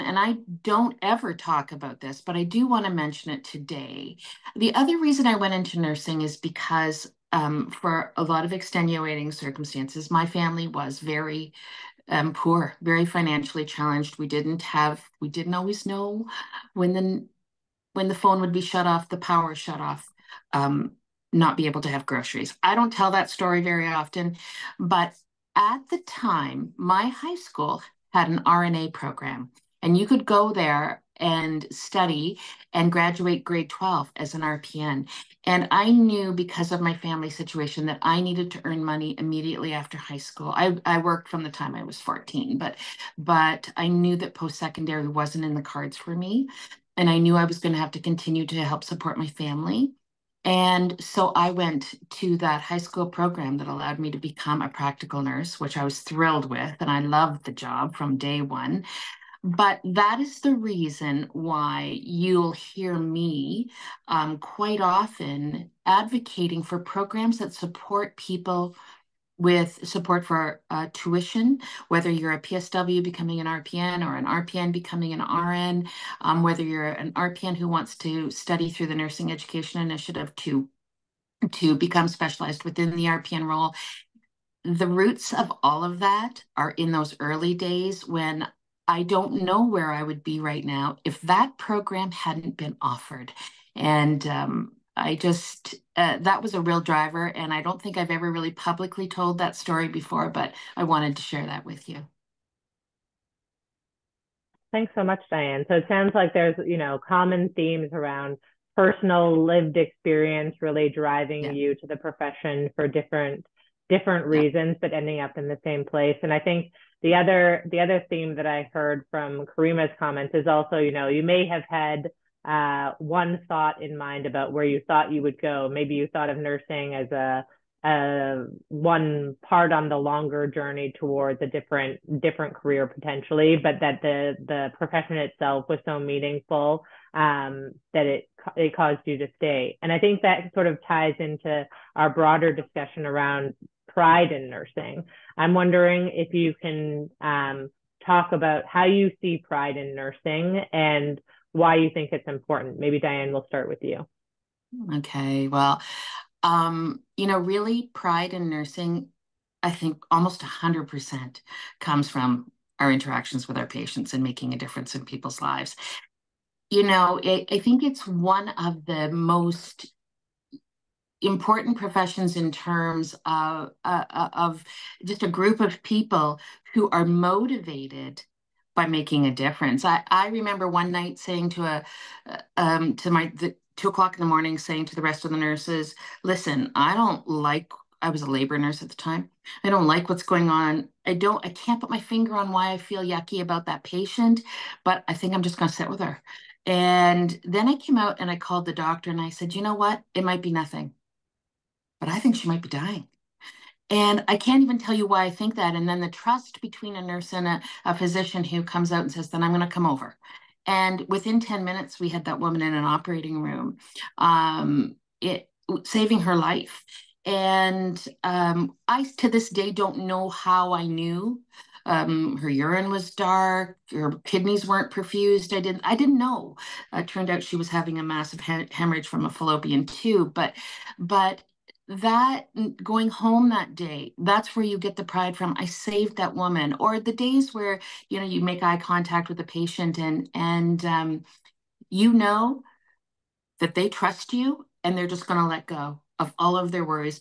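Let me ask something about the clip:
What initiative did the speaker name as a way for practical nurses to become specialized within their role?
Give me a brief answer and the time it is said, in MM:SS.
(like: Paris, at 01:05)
Nursing Education Initiative, at 01:18.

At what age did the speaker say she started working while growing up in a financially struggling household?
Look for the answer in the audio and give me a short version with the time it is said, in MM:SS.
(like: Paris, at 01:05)
14, at 00:42.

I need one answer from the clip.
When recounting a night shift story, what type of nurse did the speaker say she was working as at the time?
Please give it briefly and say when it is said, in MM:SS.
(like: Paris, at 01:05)
Labor nurse, at 03:08.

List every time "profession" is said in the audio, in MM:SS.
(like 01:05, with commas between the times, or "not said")
01:51, 02:14, 02:51.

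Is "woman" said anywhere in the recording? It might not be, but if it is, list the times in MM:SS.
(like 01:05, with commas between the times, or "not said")
03:32, 03:56.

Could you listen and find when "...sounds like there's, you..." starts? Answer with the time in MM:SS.
01:45.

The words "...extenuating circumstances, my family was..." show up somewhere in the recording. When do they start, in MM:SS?
00:08.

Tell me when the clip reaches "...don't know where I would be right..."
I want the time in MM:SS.
01:29.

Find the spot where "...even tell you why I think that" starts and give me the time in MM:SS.
03:24.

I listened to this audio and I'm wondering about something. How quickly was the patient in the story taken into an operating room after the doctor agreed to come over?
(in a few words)
Within 10 minutes.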